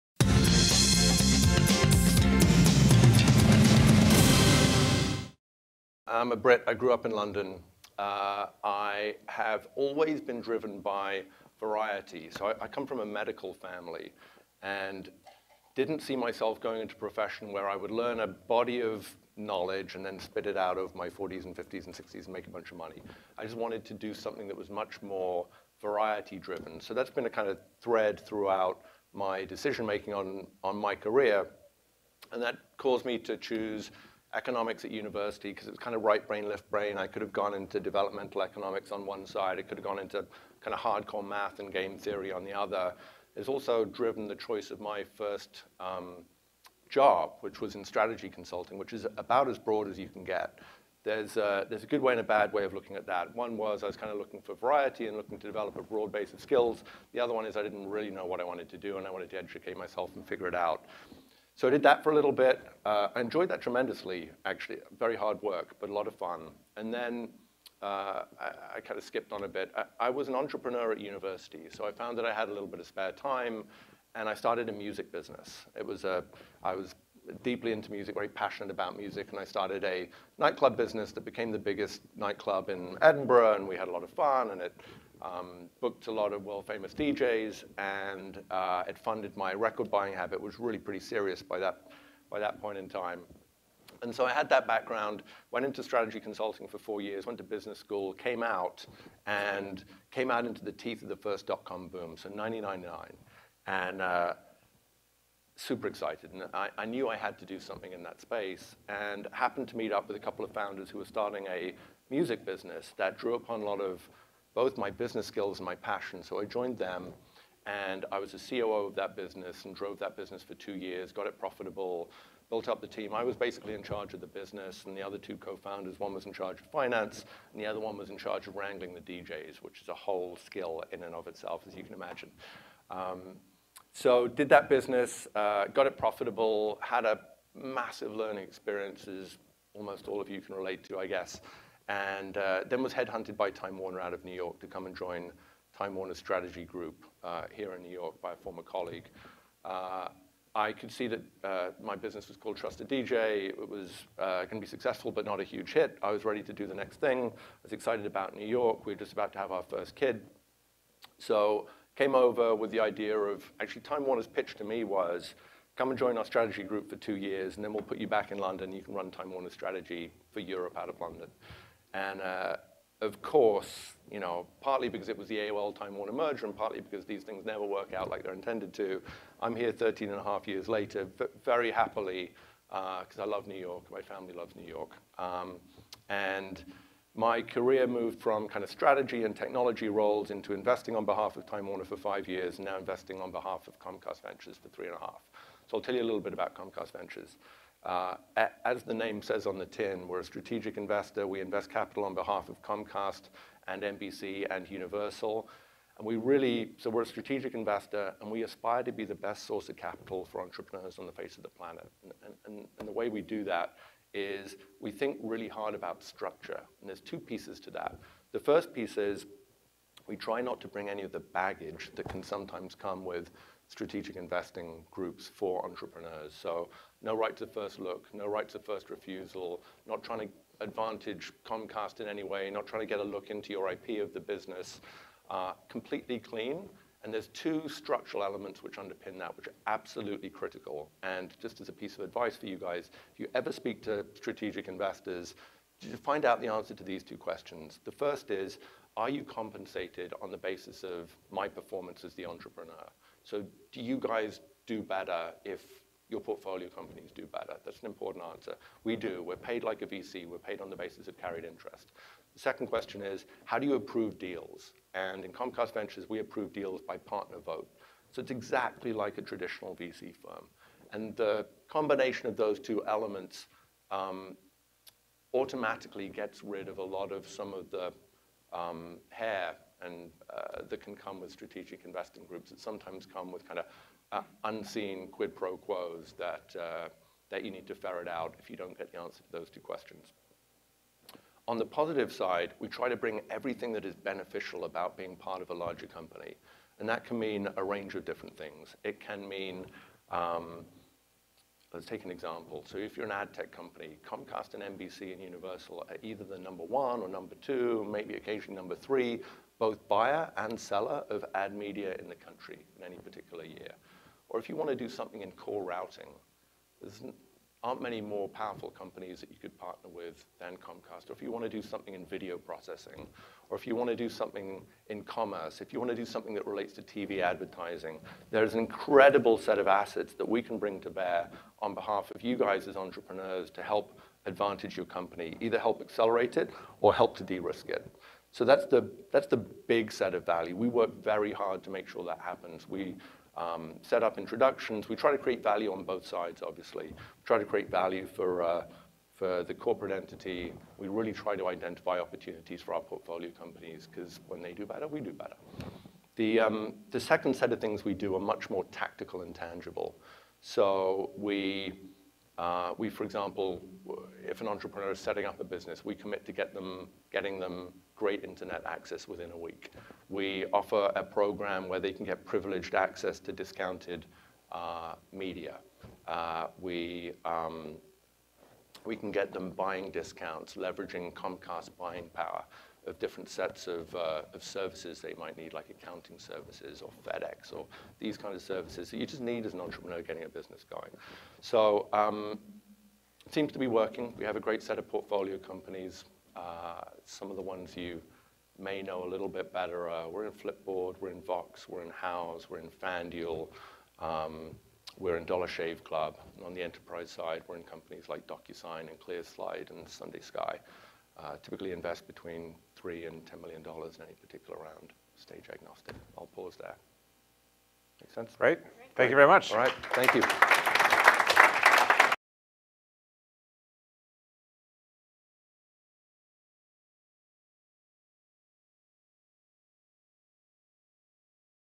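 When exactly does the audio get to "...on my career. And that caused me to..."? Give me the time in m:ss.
0:30.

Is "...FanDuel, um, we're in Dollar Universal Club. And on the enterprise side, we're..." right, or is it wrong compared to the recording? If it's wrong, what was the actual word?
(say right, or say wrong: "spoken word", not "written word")
wrong: "Shave", not "Universal".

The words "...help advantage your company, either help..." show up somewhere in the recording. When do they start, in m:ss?
5:33.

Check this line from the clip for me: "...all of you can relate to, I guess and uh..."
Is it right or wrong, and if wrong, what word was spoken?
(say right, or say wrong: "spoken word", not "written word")
right.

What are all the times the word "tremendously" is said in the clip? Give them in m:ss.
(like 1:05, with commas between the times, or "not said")
1:03.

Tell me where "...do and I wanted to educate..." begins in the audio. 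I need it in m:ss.
0:58.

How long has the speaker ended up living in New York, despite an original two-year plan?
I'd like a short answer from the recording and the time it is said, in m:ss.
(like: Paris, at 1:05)
13.5 years, at 2:59.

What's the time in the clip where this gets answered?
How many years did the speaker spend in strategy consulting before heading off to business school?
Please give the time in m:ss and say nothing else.
1:36.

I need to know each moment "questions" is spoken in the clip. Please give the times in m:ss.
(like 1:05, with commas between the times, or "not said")
4:07, 4:22, 4:49.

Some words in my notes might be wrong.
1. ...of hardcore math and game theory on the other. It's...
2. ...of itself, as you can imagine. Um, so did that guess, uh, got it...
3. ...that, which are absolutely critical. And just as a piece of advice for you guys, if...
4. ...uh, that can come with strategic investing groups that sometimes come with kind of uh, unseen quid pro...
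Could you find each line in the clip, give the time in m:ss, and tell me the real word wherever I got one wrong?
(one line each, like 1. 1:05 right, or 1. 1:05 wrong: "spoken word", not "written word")
1. 0:40 right
2. 2:11 wrong: "business", not "guess"
3. 3:59 right
4. 4:40 right.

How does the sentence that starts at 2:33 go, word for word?
It was uh, going to be successful, but not a huge hit.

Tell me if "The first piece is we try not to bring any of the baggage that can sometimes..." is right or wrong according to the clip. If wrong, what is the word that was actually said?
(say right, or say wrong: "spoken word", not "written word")
right.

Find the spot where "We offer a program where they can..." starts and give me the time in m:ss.
6:10.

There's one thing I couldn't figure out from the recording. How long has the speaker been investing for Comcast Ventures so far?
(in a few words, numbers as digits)
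3.5 years.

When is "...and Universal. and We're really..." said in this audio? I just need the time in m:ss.
3:24.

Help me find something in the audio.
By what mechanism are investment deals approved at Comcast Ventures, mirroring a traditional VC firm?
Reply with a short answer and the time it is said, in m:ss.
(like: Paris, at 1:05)
Partner vote, at 4:26.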